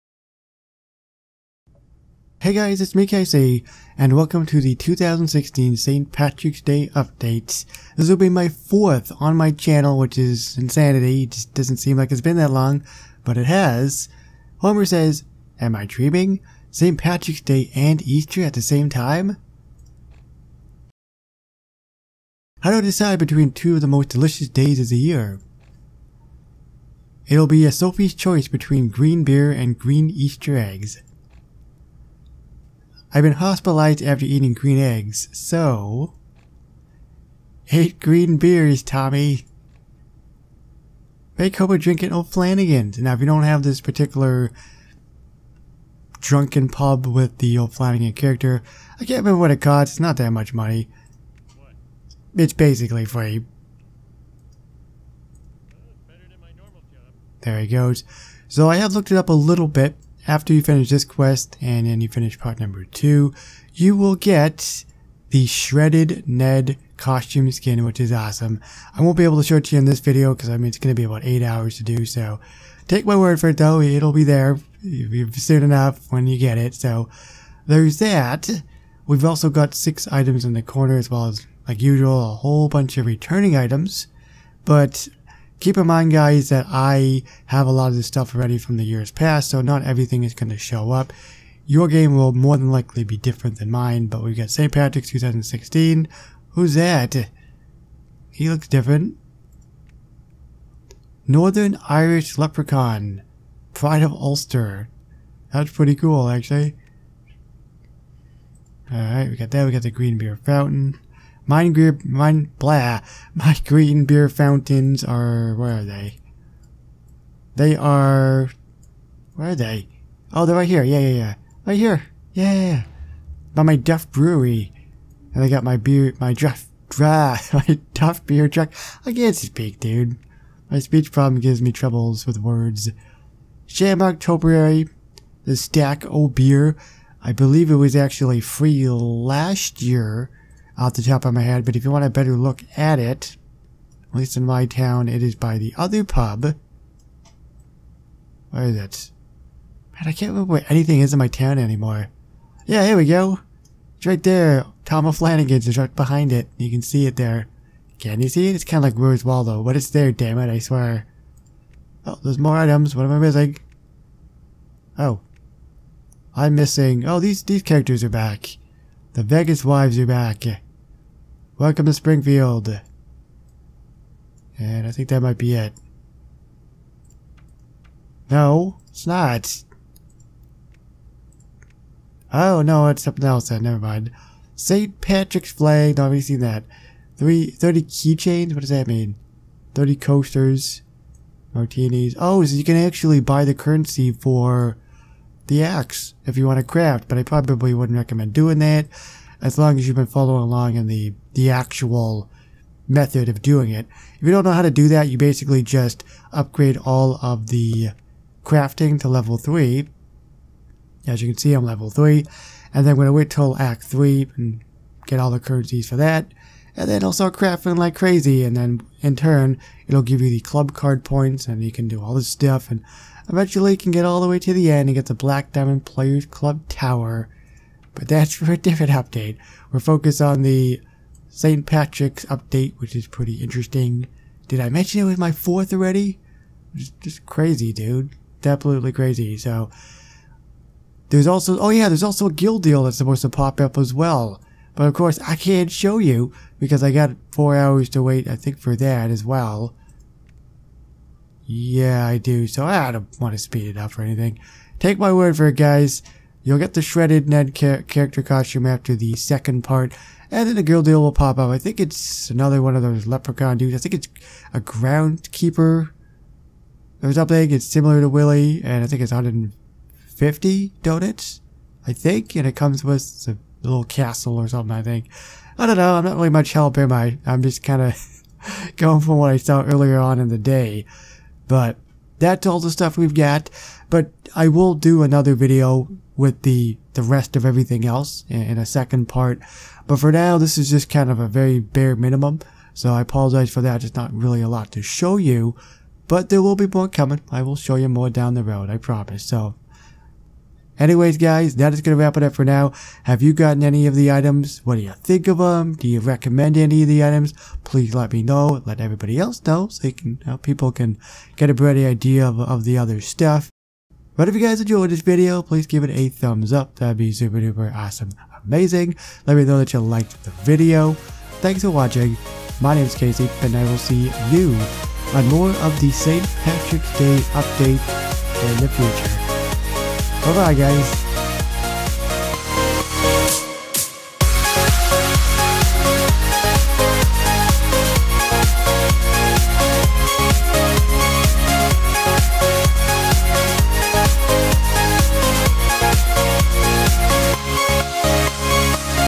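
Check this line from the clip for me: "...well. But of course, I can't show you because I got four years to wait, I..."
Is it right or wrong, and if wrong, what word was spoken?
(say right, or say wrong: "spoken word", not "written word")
wrong: "hours", not "years".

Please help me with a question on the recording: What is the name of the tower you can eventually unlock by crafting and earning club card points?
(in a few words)
Black Diamond Players Club Tower.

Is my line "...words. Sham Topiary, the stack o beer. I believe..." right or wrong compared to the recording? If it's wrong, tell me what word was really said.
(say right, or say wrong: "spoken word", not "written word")
right.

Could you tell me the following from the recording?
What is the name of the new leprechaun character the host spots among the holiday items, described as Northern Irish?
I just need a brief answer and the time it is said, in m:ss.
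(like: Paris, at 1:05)
Pride of Ulster, at 1:43.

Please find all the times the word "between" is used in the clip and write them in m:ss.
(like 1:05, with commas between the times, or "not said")
0:23, 0:28.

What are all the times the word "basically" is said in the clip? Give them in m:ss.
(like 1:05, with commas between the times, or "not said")
0:52, 3:25.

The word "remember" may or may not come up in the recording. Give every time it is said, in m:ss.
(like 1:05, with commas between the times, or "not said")
0:49, 2:30.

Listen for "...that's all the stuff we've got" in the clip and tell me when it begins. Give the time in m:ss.
4:42.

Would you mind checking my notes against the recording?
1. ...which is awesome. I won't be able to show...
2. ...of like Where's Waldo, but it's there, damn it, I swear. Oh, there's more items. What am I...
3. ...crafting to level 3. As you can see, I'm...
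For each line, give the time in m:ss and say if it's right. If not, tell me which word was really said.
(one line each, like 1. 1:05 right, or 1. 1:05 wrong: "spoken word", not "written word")
1. 1:07 right
2. 2:38 right
3. 3:28 right.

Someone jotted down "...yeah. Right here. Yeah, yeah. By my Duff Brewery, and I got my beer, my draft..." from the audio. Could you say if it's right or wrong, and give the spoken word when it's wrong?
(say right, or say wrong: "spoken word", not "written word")
right.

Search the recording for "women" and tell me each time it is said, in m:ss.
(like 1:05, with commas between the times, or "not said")
not said.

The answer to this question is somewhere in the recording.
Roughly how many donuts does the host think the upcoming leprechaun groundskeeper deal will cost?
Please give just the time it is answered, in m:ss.
4:29.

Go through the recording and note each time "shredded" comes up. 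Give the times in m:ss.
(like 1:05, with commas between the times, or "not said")
1:05, 4:16.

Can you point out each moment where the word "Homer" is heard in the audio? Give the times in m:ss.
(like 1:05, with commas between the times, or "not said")
0:14, 0:41.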